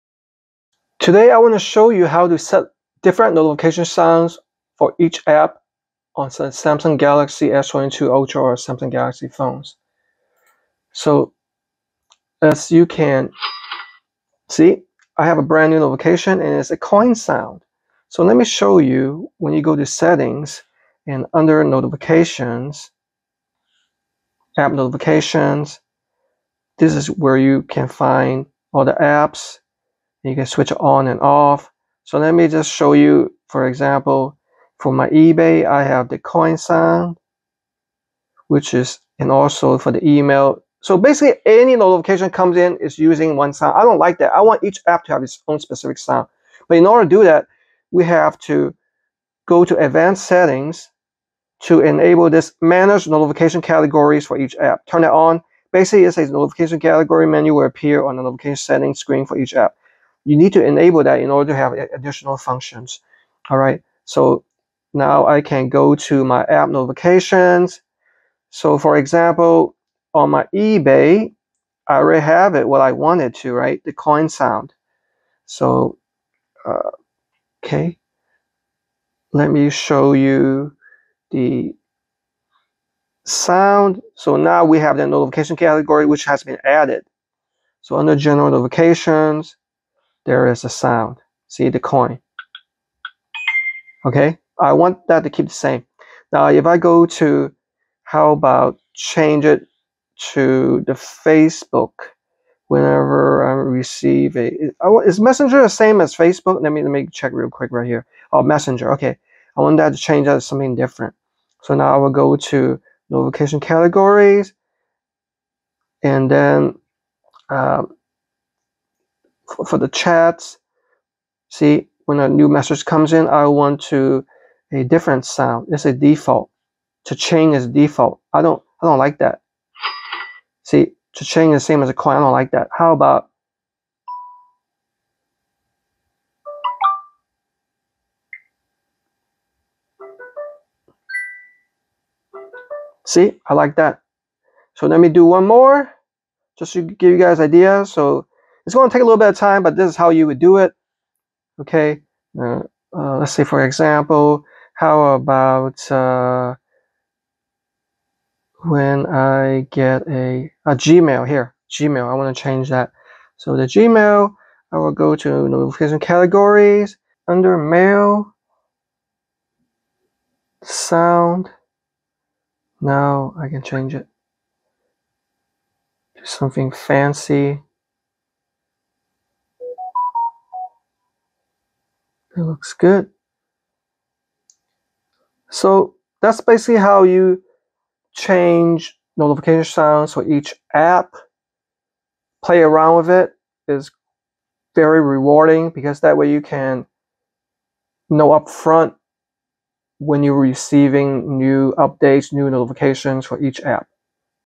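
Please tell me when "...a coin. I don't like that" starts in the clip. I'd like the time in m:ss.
2:11.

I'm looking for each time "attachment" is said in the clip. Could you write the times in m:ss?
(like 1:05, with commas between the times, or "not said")
not said.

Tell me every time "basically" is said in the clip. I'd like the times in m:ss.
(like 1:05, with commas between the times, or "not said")
0:40, 0:55, 3:06.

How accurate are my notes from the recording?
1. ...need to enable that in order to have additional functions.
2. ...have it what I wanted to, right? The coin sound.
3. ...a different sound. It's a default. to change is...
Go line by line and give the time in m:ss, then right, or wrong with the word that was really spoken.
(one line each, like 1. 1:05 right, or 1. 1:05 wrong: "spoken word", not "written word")
1. 1:00 right
2. 1:12 right
3. 2:04 right.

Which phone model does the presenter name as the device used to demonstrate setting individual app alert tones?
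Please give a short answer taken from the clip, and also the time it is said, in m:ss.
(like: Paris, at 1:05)
Samsung Galaxy S22 Ultra, at 0:06.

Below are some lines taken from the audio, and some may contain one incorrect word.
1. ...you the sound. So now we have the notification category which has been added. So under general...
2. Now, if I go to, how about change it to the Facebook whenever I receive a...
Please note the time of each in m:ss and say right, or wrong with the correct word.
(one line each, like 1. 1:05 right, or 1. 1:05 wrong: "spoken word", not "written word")
1. 1:20 right
2. 1:36 right.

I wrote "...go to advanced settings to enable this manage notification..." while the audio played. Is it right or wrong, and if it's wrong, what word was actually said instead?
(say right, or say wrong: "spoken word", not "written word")
right.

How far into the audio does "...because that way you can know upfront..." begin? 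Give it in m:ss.
3:15.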